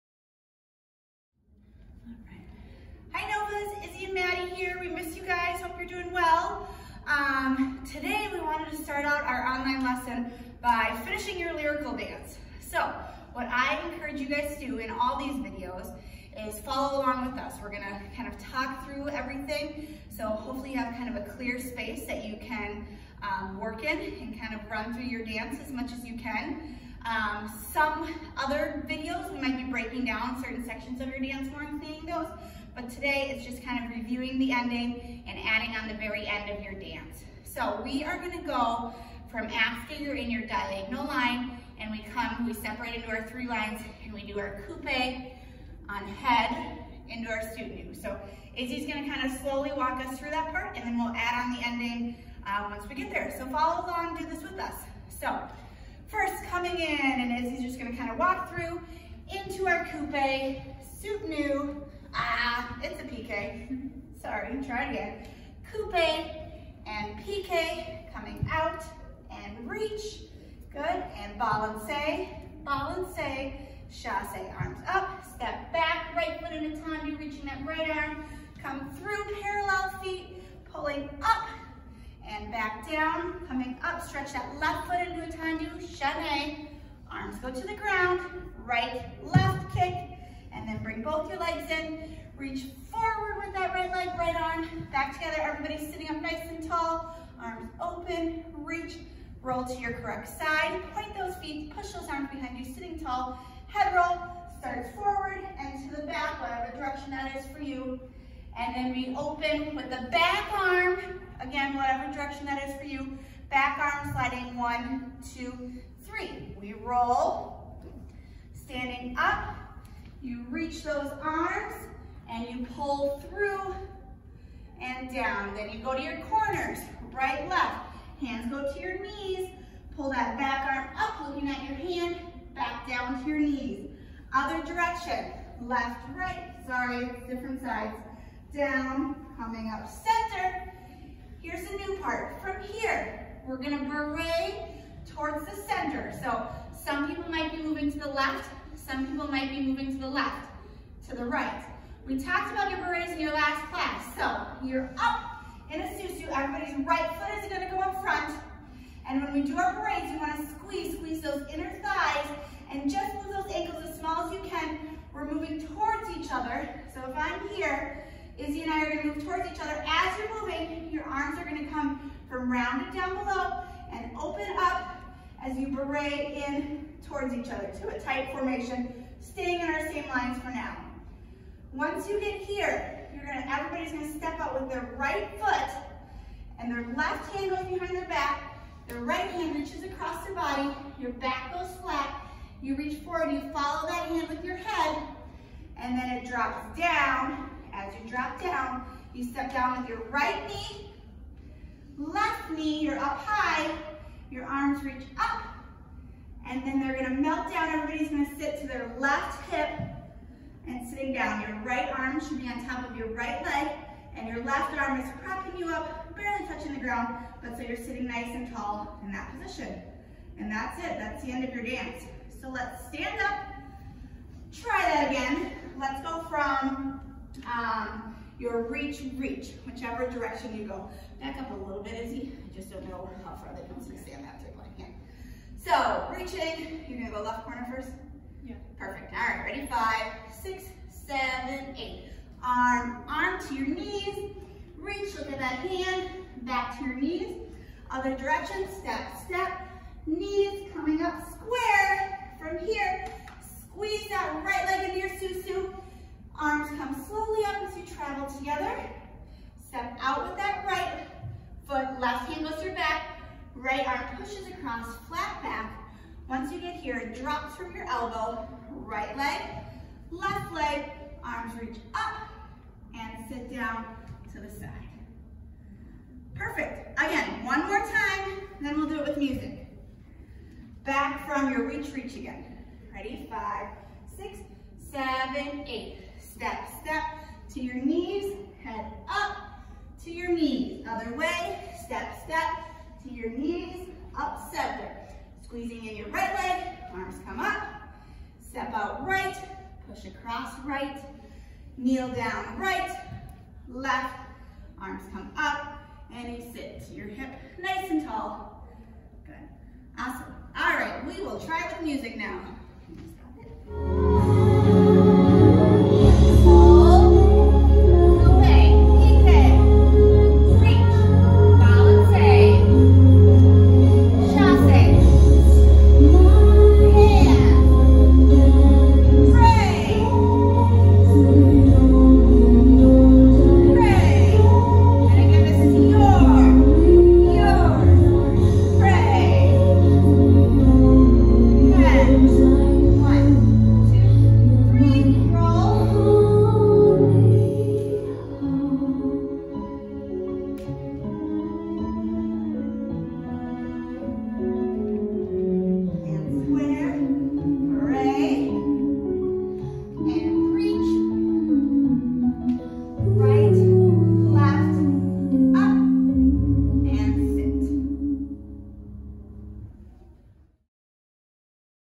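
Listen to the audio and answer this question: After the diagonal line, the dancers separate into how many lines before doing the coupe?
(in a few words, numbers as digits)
3.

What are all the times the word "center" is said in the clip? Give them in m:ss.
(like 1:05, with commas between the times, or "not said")
2:19, 2:25, 4:54.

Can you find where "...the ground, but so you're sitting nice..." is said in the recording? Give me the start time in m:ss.
3:36.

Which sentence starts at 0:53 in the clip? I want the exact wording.
So follow along, do this with us.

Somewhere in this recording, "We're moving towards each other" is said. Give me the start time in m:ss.
2:45.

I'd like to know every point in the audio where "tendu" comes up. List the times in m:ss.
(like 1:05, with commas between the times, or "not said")
1:16, 1:25.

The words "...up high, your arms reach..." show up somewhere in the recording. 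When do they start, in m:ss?
3:22.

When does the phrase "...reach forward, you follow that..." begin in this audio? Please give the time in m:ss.
3:12.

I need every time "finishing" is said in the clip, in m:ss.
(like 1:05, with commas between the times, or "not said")
0:11.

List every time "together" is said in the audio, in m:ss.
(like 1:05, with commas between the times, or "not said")
1:35, 4:18.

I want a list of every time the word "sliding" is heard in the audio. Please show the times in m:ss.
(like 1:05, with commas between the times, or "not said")
1:54.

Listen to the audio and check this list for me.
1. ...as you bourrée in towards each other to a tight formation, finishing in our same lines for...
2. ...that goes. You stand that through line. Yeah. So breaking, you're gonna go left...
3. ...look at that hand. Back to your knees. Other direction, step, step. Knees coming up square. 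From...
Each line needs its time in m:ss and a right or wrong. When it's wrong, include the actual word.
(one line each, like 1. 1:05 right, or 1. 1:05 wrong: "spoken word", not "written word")
1. 2:55 wrong: "staying", not "finishing"
2. 3:53 wrong: "reaching", not "breaking"
3. 4:05 right.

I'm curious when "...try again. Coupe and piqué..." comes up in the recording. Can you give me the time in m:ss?
1:04.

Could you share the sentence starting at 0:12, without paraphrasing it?
So what I encourage you guys to do in all these videos is follow along with us.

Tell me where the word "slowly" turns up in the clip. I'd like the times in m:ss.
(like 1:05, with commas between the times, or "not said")
0:49, 4:17.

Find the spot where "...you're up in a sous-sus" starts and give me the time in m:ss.
2:34.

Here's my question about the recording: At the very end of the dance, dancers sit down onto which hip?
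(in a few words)
left hip.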